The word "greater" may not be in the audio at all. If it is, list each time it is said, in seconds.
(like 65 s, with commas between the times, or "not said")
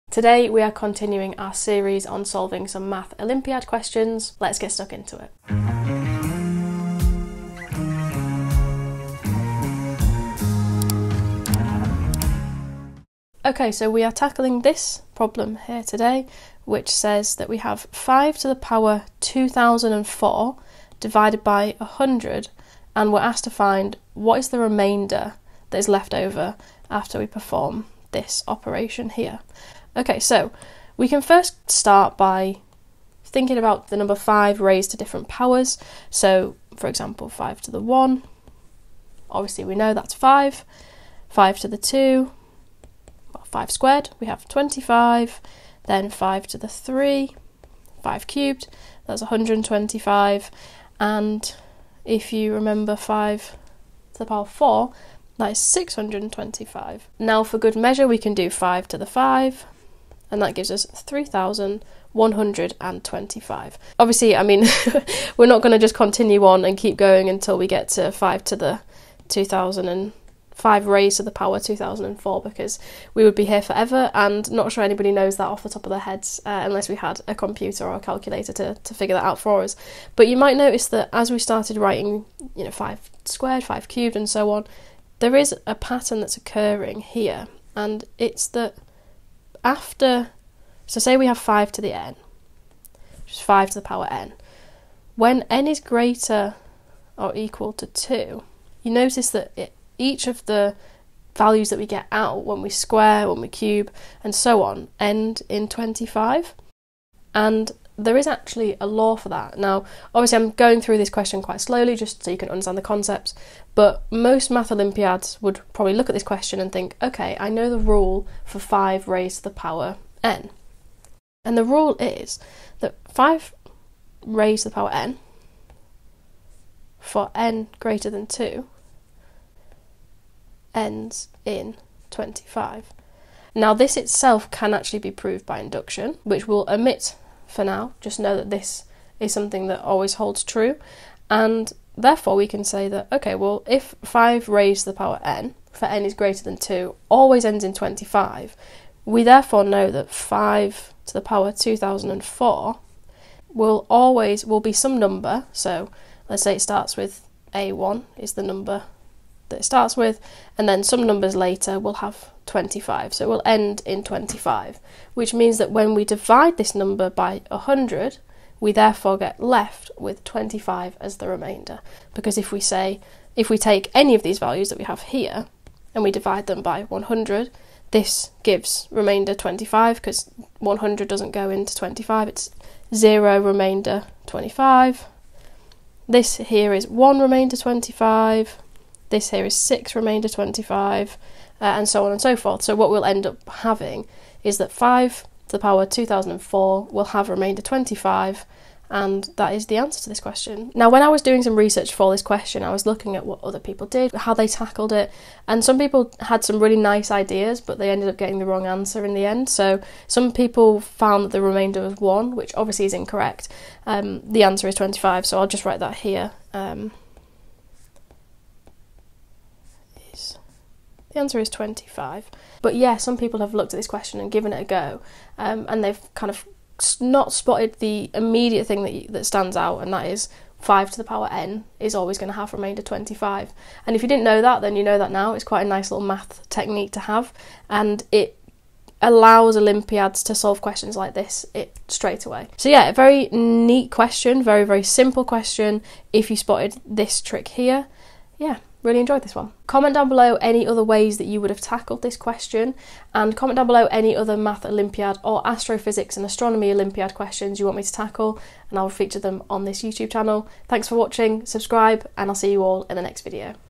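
95 s, 127 s, 146 s.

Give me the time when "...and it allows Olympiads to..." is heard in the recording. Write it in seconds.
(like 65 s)
237 s.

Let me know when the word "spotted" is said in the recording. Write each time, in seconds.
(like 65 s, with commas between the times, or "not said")
227 s, 246 s.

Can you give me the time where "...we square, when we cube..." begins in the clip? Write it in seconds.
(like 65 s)
102 s.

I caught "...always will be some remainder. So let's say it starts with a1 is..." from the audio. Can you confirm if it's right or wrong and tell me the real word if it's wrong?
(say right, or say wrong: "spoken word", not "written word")
wrong: "number", not "remainder".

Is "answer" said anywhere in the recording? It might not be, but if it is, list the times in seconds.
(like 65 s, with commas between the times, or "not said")
199 s, 208 s, 214 s, 221 s.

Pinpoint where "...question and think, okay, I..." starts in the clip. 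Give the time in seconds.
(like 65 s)
116 s.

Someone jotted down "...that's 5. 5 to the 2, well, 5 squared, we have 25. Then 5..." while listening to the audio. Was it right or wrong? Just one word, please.
right.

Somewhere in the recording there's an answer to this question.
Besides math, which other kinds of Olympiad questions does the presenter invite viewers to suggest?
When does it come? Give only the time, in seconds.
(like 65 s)
255 s.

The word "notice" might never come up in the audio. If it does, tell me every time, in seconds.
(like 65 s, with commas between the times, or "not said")
80 s, 98 s.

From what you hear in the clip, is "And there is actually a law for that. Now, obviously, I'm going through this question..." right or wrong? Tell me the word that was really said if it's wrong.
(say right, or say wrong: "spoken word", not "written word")
right.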